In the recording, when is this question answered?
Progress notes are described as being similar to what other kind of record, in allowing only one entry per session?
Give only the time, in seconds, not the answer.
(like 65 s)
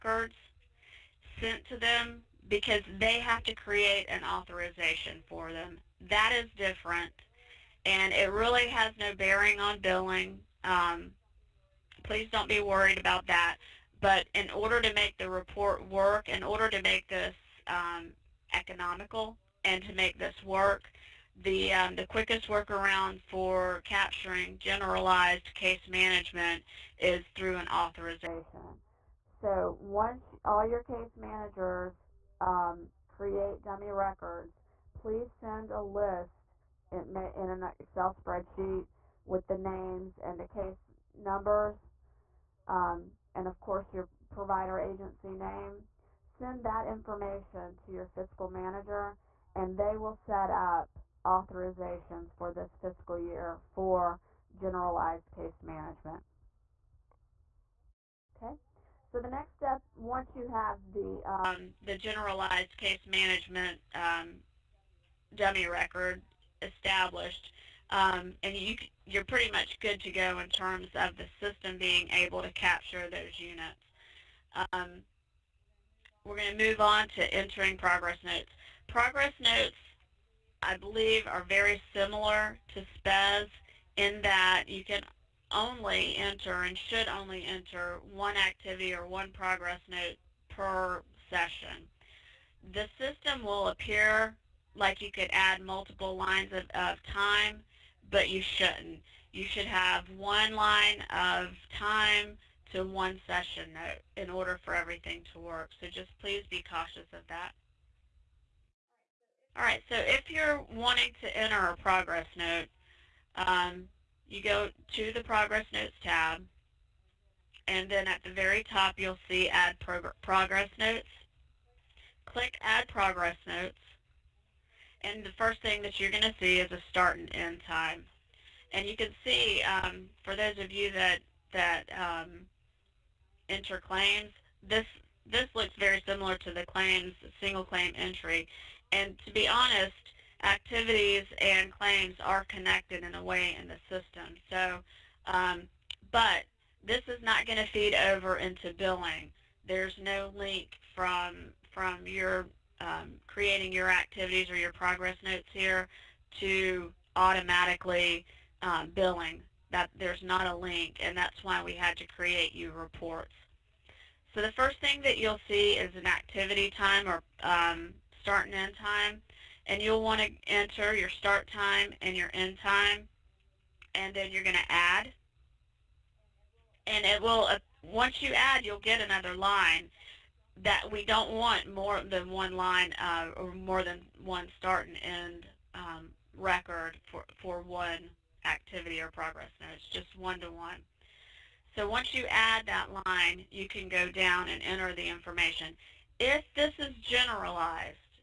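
82 s.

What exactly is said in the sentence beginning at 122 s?
Click Add Progress Notes, and the first thing that you're going to see is a start and end time.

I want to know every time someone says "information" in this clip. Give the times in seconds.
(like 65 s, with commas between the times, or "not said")
46 s, 195 s.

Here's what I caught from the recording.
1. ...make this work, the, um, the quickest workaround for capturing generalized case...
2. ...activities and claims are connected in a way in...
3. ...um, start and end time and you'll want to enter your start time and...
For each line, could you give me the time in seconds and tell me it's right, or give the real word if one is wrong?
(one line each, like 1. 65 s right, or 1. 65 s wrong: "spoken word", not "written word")
1. 19 s right
2. 140 s right
3. 167 s right.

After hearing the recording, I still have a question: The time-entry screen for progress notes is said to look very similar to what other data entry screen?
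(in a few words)
Single claim entry.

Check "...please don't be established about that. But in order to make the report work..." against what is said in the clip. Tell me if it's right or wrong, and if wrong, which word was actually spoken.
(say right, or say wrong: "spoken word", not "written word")
wrong: "worried", not "established".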